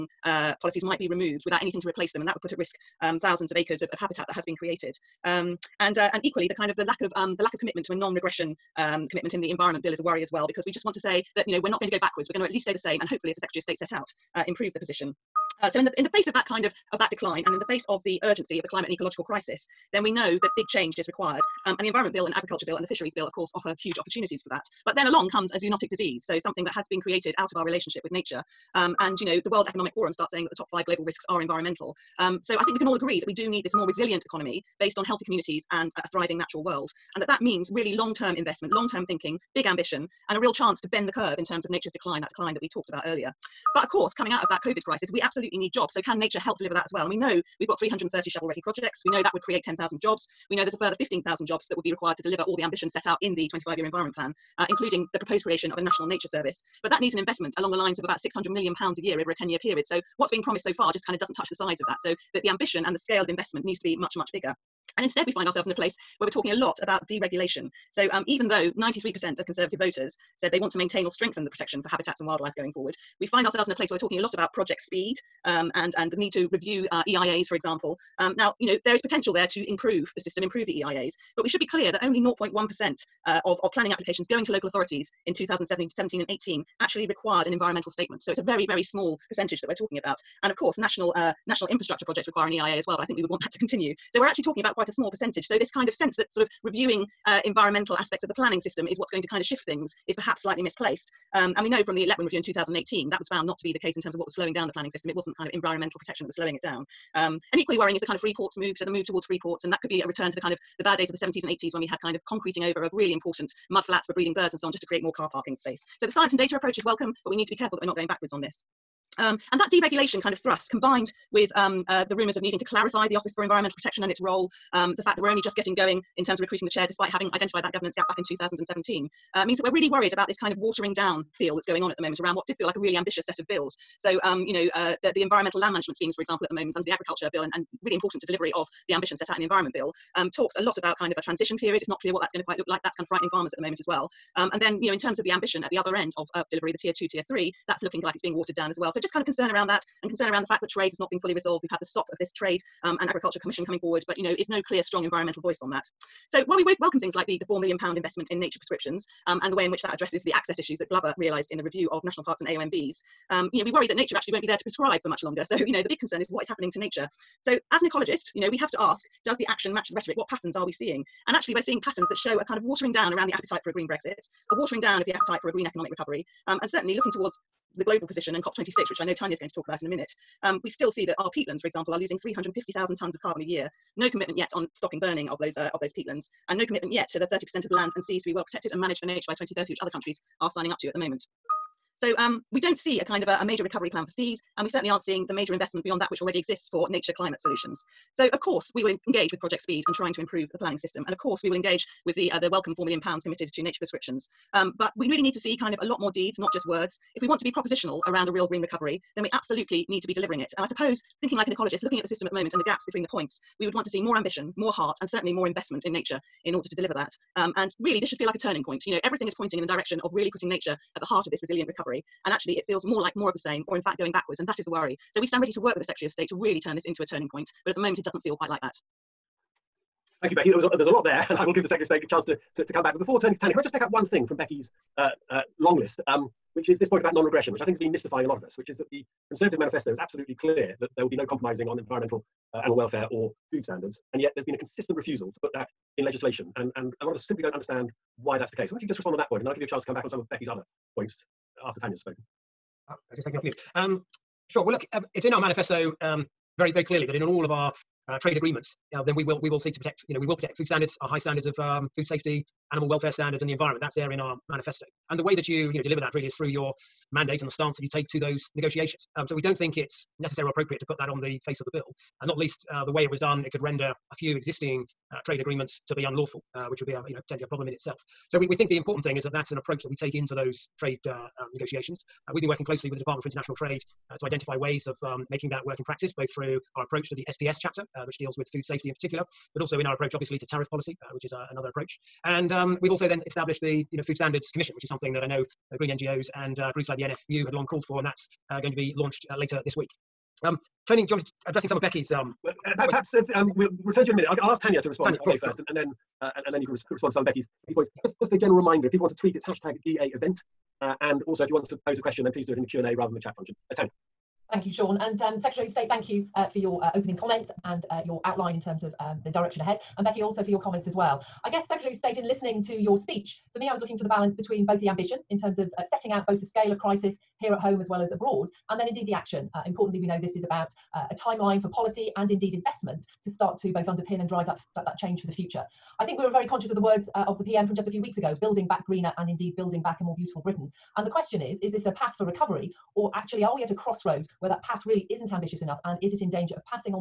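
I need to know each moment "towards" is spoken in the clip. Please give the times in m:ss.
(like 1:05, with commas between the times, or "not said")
1:49, 2:57.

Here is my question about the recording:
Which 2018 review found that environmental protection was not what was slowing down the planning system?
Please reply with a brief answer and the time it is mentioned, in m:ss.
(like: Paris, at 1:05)
Letwin review, at 1:42.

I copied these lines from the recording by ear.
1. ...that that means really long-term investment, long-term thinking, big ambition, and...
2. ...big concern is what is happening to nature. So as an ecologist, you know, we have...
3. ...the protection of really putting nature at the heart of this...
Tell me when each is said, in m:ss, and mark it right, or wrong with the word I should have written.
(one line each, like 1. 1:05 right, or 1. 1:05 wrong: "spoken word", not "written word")
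1. 0:37 right
2. 2:45 right
3. 3:39 wrong: "direction", not "protection".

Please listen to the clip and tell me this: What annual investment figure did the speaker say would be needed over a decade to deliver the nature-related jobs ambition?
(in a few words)
£600 million.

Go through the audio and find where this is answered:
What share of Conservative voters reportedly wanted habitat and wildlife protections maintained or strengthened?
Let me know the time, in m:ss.
1:08.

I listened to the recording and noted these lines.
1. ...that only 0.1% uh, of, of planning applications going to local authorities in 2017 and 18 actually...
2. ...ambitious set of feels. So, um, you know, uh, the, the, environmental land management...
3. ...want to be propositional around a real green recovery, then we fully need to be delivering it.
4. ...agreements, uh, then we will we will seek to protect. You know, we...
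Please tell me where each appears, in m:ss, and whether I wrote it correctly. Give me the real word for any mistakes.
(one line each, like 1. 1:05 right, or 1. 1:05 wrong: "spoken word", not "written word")
1. 1:21 right
2. 2:12 wrong: "bills", not "feels"
3. 3:27 wrong: "absolutely", not "fully"
4. 4:18 right.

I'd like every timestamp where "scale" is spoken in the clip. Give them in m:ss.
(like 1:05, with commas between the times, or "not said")
1:02, 5:26.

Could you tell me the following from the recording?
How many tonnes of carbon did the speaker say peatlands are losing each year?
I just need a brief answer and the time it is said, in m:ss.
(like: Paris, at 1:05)
350,000 tonnes, at 3:02.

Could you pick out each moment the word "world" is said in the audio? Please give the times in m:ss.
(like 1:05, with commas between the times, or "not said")
0:29, 0:36.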